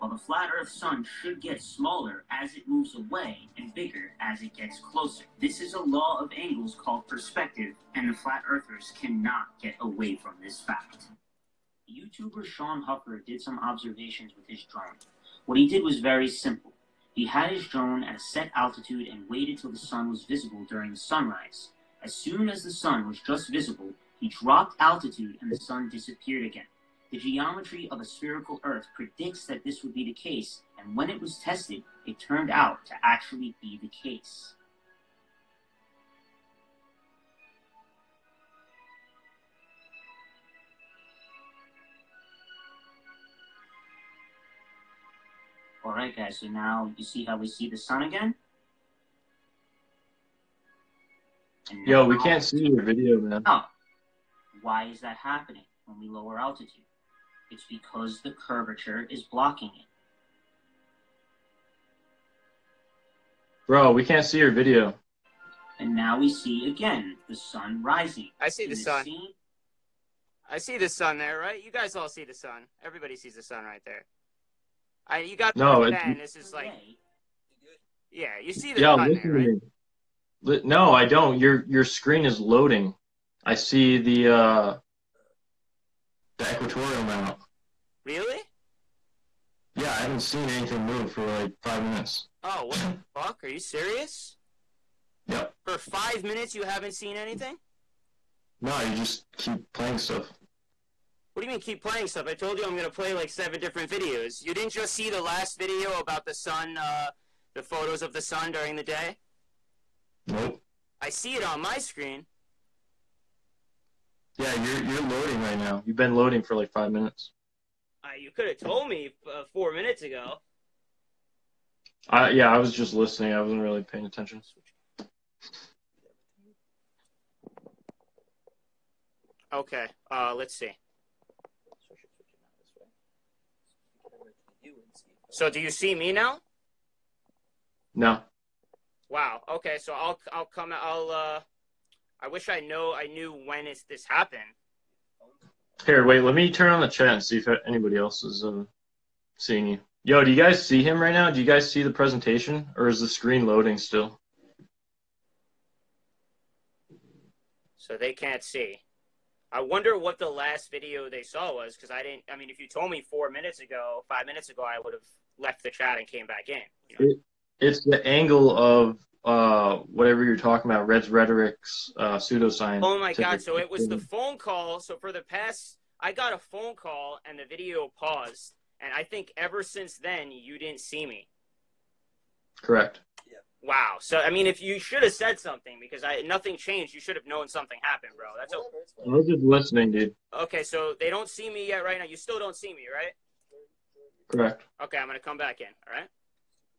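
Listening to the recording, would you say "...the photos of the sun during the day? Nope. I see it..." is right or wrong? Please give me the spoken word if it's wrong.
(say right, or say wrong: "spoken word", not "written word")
right.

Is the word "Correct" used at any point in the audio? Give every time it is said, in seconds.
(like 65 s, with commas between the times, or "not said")
182 s, 194 s.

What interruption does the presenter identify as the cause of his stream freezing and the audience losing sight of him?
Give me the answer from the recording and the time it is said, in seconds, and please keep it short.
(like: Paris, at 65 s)
a phone call, at 173 s.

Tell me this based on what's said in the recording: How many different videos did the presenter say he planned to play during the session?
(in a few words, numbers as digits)
7.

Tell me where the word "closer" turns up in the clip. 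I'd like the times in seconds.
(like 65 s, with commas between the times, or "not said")
4 s.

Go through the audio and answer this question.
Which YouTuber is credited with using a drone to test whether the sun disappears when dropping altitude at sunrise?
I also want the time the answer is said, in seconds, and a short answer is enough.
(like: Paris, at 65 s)
Sean Hucker, at 12 s.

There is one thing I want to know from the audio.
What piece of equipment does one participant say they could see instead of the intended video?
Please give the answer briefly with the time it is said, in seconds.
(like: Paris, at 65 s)
the equatorial mount, at 86 s.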